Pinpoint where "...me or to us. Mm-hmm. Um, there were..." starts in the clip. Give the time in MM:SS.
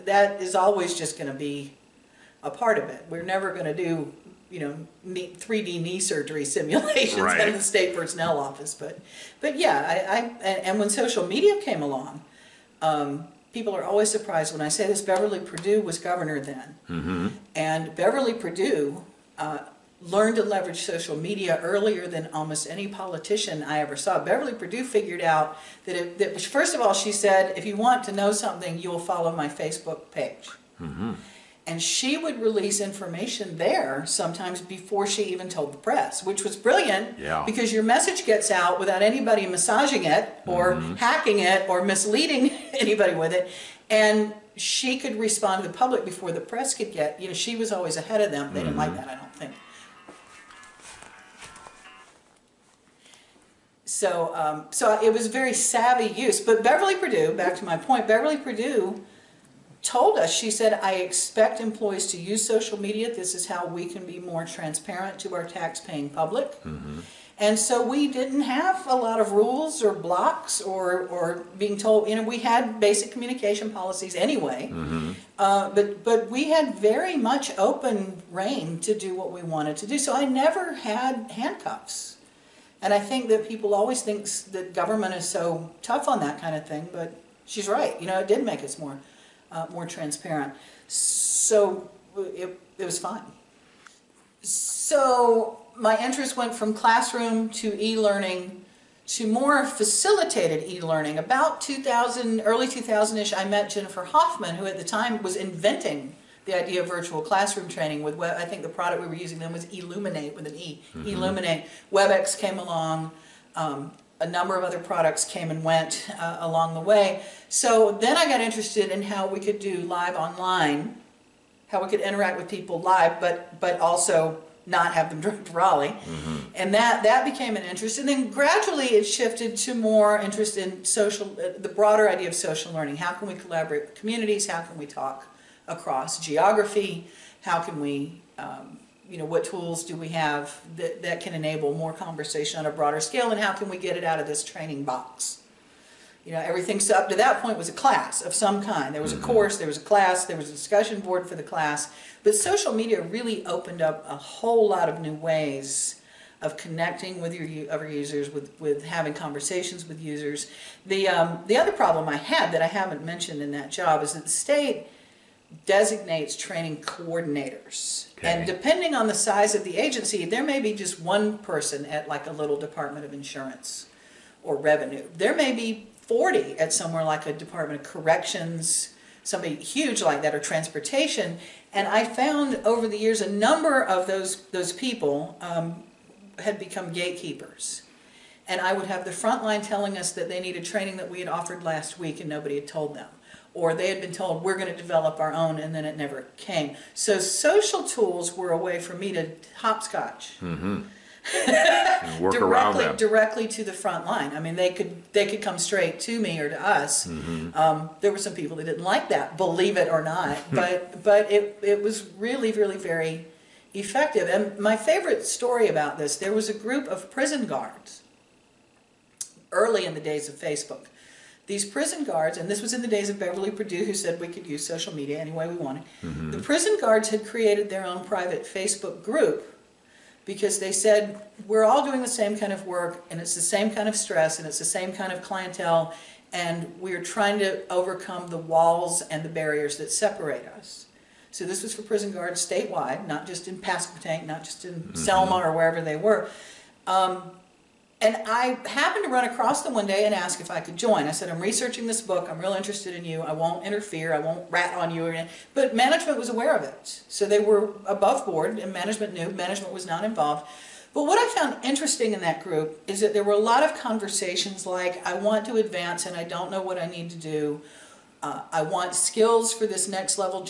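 03:26.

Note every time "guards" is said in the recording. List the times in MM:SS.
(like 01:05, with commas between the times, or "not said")
03:37, 03:42, 03:46, 04:02.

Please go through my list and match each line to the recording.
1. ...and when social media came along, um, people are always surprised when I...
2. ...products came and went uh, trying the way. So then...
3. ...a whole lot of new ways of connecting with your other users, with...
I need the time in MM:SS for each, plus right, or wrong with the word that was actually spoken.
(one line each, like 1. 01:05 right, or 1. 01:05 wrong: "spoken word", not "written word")
1. 00:10 right
2. 01:54 wrong: "along", not "trying"
3. 02:34 right.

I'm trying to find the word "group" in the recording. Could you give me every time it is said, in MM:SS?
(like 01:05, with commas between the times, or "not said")
03:36, 03:49, 04:22.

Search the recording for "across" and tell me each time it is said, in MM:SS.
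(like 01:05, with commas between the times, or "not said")
02:15, 04:09.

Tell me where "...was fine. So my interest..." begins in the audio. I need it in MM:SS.
01:32.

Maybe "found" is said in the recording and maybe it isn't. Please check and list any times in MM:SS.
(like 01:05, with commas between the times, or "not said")
03:02, 04:21.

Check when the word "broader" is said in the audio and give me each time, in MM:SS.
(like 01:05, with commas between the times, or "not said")
02:11, 02:22.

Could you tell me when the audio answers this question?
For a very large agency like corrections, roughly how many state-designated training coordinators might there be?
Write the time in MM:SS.
02:56.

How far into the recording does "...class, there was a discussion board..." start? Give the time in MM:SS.
02:29.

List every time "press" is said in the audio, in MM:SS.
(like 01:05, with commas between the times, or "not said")
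00:35, 00:46.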